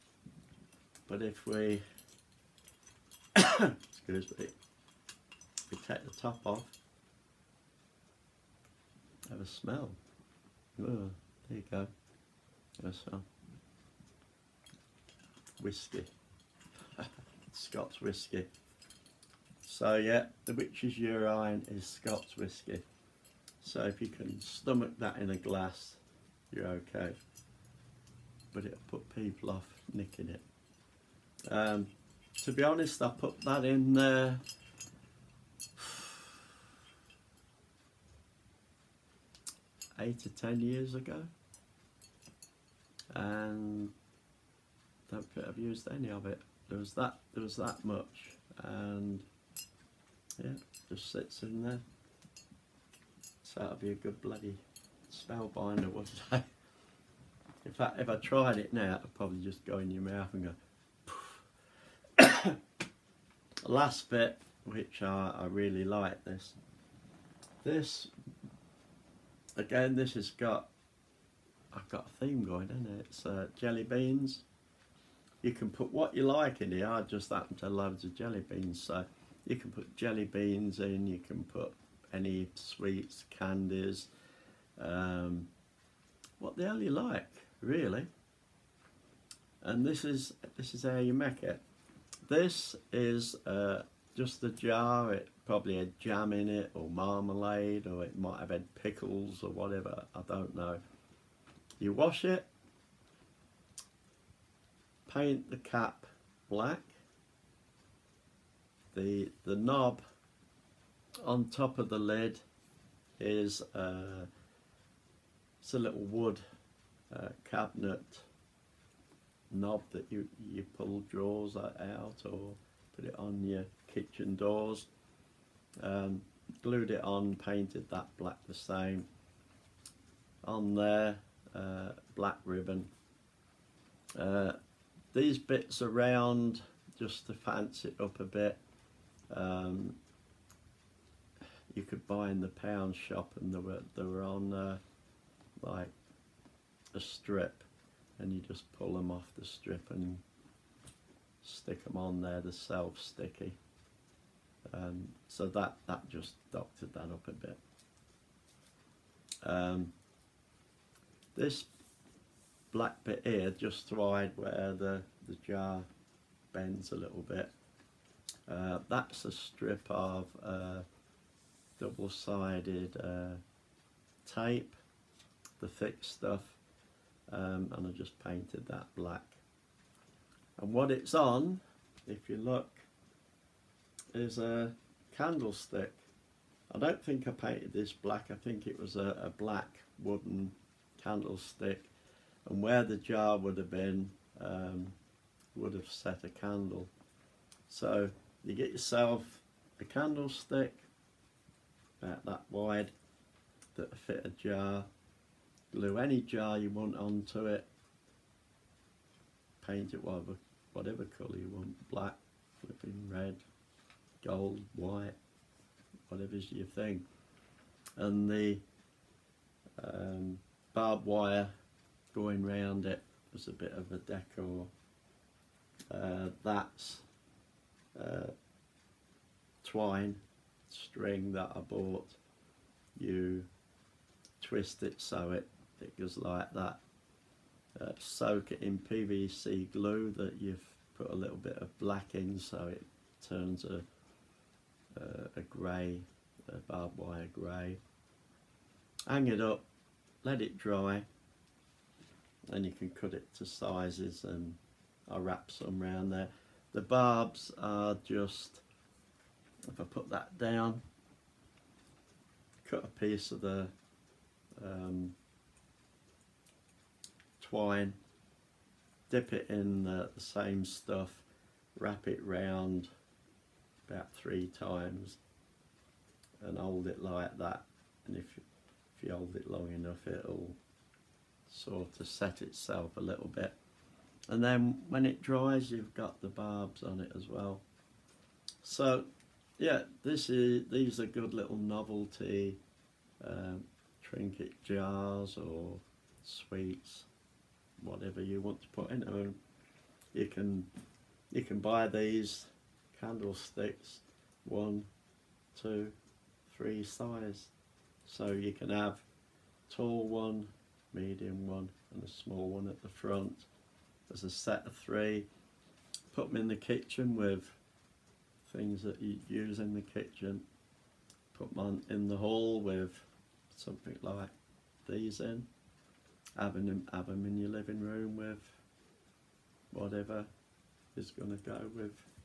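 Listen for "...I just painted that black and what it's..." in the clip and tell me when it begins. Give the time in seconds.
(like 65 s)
177 s.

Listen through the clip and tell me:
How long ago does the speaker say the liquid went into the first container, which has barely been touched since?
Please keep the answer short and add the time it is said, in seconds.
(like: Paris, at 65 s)
8 to 10 years, at 40 s.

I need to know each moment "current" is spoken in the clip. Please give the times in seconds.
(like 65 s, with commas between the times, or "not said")
not said.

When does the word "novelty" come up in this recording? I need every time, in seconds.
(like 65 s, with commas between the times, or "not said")
291 s.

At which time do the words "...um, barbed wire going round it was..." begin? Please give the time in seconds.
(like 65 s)
219 s.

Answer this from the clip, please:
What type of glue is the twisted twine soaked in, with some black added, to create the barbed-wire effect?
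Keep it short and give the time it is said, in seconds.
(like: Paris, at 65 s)
PVC glue, at 238 s.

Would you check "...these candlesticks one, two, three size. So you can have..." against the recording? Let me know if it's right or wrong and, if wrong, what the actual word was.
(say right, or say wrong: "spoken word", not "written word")
right.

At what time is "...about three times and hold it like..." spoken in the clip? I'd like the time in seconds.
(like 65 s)
273 s.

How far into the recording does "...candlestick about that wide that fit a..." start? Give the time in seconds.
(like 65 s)
199 s.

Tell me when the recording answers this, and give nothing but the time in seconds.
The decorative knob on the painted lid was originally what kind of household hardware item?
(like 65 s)
117 s.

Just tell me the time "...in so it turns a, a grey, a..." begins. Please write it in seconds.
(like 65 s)
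242 s.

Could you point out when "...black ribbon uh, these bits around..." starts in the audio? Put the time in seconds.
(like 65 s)
132 s.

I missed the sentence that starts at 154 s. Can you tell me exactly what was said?
Um, so that, that just doctored that up a bit.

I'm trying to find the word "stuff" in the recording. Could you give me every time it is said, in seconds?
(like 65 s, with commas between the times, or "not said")
176 s, 270 s.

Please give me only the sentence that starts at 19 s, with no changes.
So yeah, the witch's urine is Scots whiskey.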